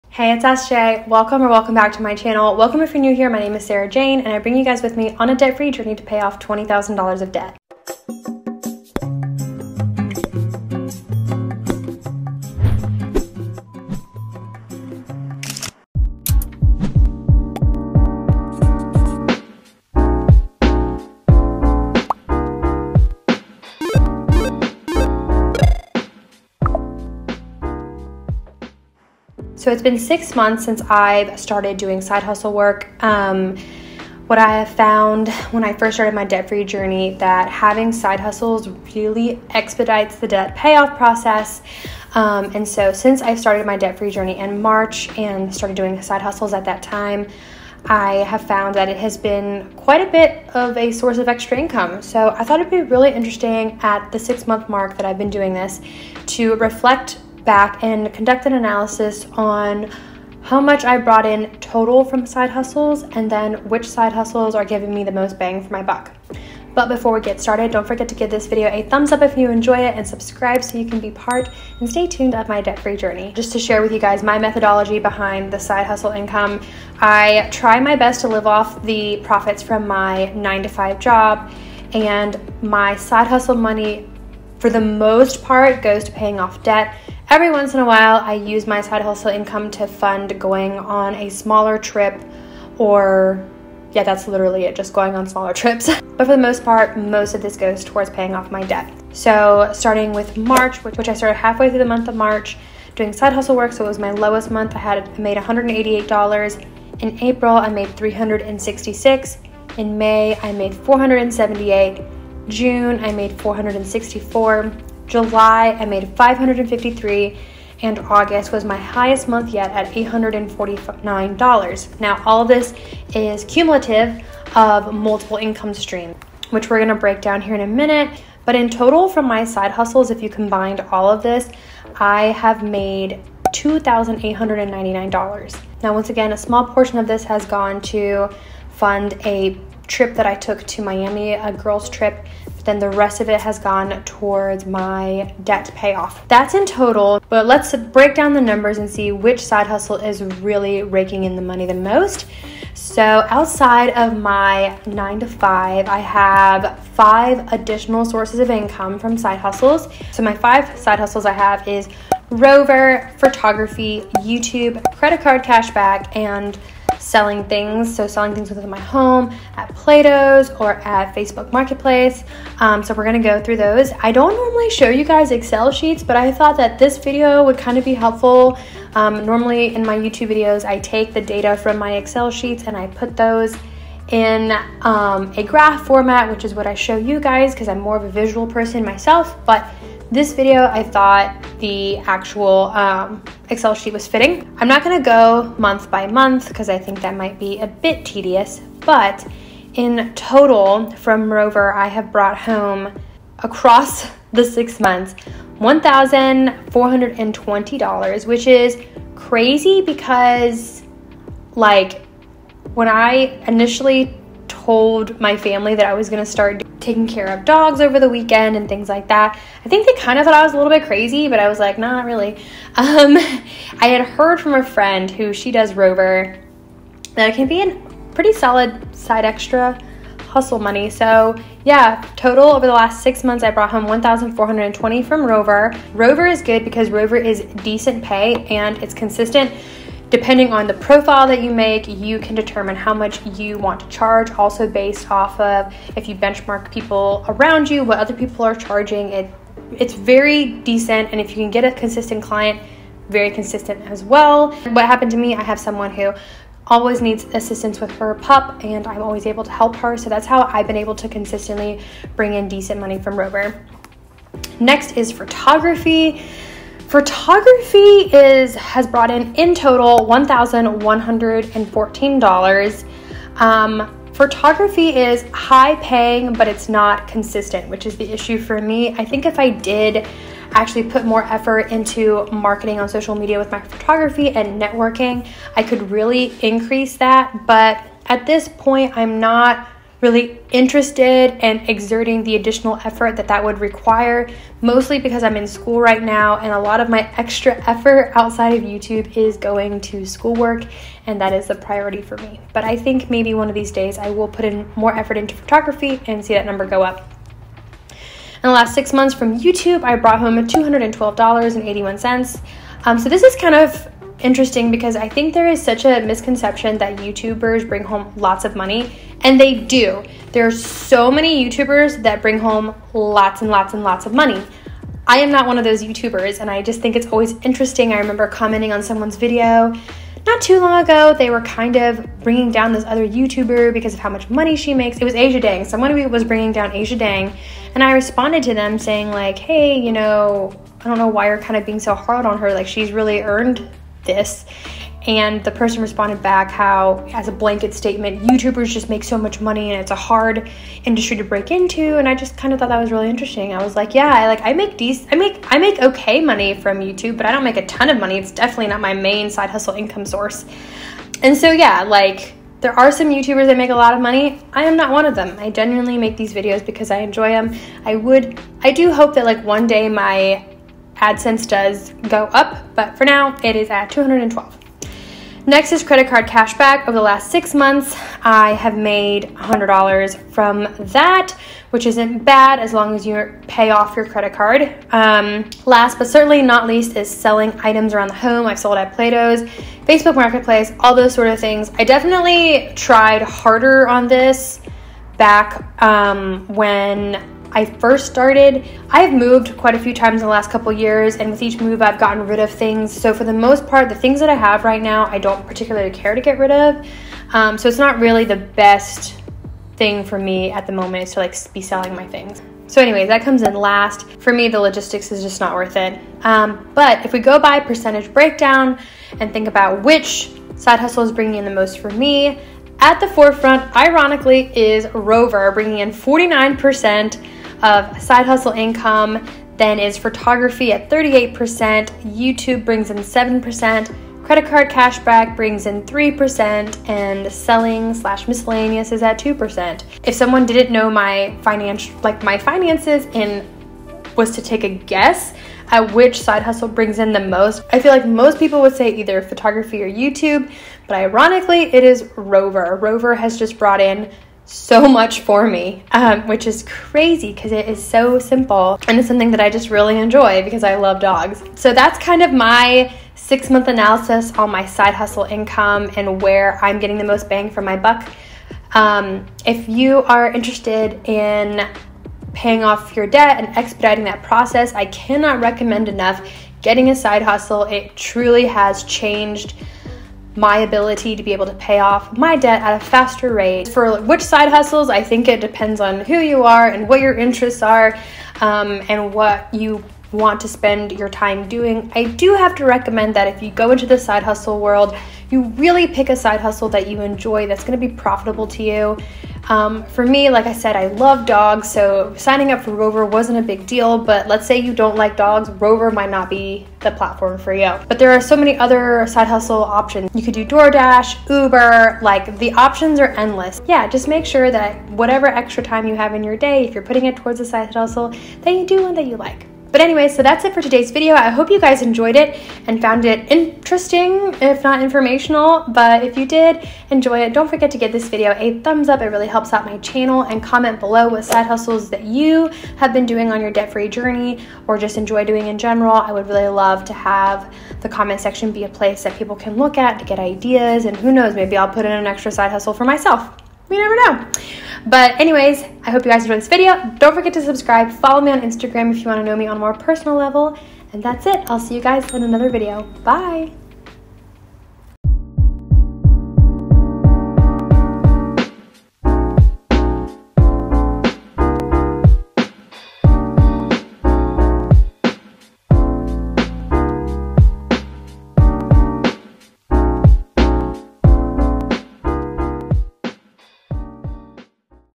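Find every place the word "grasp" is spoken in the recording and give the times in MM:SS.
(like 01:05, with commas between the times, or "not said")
not said.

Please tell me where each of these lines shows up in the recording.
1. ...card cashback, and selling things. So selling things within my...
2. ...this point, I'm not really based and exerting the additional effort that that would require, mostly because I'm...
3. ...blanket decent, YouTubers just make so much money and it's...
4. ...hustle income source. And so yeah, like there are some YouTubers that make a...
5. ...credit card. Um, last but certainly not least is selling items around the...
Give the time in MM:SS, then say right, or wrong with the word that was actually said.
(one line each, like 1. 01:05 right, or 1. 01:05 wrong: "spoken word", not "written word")
1. 02:45 right
2. 04:48 wrong: "interested", not "based"
3. 05:47 wrong: "statement", not "decent"
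4. 05:59 right
5. 06:24 right.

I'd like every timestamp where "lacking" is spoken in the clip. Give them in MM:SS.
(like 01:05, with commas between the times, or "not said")
not said.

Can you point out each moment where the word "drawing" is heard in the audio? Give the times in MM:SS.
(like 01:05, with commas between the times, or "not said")
not said.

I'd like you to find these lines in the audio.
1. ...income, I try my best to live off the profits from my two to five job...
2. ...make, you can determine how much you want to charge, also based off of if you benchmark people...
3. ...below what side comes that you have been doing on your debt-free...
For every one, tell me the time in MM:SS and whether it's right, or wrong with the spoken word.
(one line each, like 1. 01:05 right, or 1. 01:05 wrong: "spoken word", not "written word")
1. 01:16 wrong: "nine", not "two"
2. 04:01 right
3. 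08:50 wrong: "hustles", not "comes".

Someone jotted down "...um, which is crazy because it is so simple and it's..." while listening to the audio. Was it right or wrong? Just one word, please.
right.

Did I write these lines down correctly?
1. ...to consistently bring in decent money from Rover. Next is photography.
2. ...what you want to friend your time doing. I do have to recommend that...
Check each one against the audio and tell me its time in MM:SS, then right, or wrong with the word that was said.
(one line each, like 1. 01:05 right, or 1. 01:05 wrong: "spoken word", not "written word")
1. 04:20 right
2. 08:09 wrong: "spend", not "friend".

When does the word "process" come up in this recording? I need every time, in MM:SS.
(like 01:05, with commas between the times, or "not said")
00:40, 07:54.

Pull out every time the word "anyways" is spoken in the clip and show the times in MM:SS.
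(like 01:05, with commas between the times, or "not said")
06:52, 08:39, 09:05.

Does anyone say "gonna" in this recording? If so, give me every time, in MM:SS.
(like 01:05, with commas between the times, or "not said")
02:06, 02:53, 03:14, 03:36, 08:17.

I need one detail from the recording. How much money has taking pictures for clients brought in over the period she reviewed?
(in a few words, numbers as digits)
$1,114.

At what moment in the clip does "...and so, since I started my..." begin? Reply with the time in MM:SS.
00:42.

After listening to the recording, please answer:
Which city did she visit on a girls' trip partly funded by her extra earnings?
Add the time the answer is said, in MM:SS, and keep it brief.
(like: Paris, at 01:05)
Miami, at 02:20.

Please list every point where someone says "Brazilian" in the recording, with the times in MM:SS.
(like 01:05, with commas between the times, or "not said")
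not said.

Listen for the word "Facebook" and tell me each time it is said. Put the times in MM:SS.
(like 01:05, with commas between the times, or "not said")
02:51, 06:29.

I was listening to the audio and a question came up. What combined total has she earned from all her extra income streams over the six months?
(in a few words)
$2,899.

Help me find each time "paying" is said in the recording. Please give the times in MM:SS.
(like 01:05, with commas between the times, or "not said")
01:26, 01:38, 04:35, 07:52.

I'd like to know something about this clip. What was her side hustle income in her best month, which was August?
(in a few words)
$849.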